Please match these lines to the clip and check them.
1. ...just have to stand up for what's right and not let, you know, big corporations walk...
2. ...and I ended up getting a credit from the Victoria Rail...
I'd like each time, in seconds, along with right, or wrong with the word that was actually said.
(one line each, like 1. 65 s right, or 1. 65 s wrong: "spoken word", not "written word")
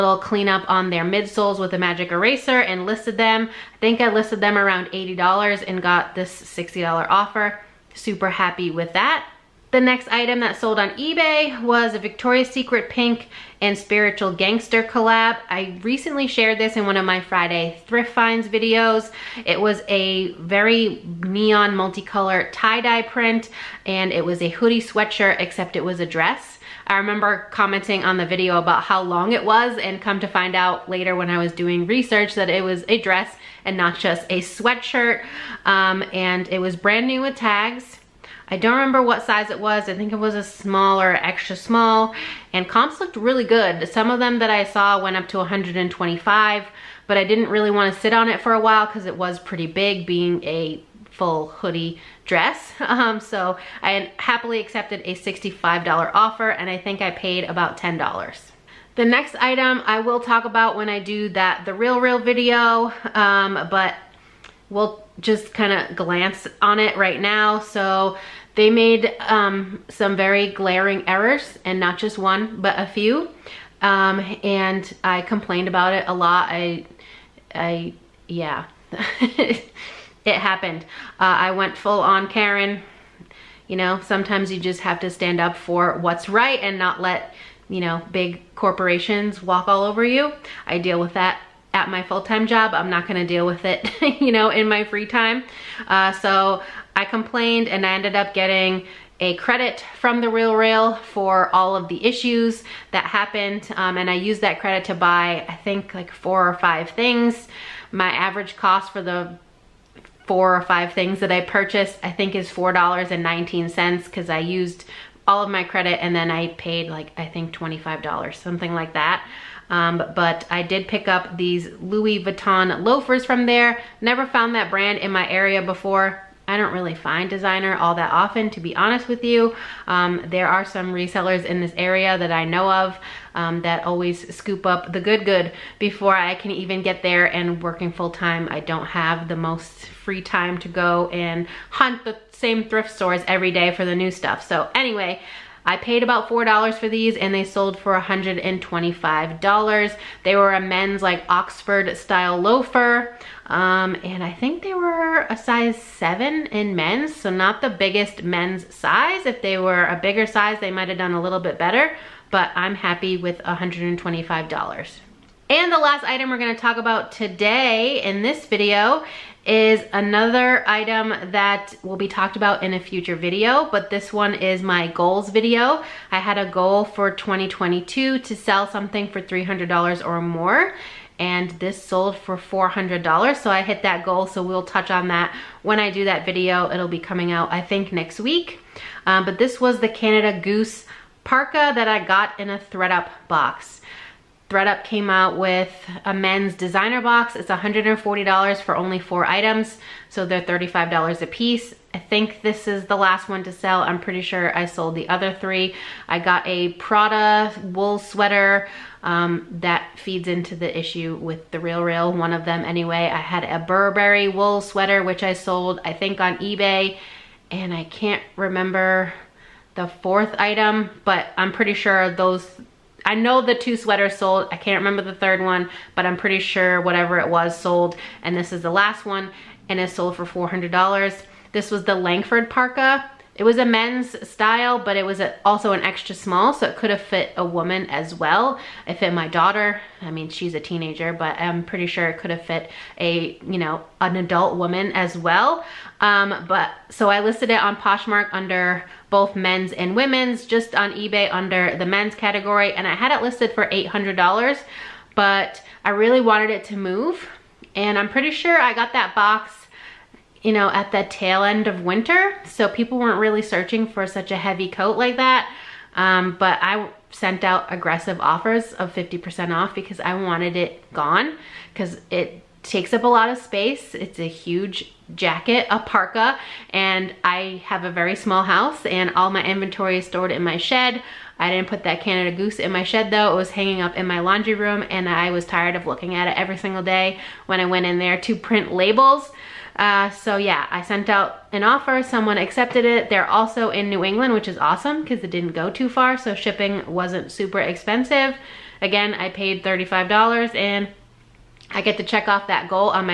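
1. 84 s right
2. 97 s wrong: "Real", not "Victoria".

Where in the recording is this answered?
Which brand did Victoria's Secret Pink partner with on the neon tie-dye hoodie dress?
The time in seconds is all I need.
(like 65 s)
13 s.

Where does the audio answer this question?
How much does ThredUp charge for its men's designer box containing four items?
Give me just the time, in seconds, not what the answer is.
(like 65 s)
197 s.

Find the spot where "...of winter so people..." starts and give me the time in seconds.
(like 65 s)
261 s.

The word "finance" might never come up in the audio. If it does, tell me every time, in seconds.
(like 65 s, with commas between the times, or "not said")
not said.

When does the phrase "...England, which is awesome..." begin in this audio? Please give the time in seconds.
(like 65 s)
294 s.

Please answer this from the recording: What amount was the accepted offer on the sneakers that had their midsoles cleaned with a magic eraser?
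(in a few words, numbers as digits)
$60.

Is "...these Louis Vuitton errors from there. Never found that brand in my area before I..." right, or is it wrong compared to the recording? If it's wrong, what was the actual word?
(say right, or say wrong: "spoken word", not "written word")
wrong: "loafers", not "errors".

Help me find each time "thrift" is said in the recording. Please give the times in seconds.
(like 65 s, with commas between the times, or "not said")
17 s, 142 s.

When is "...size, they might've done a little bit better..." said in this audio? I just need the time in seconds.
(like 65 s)
160 s.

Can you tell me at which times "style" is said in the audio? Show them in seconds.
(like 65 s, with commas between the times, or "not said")
151 s, 234 s.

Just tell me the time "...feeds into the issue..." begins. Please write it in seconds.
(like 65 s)
209 s.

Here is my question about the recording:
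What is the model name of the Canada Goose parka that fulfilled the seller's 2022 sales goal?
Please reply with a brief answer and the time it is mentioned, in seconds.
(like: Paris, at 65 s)
Langford, at 231 s.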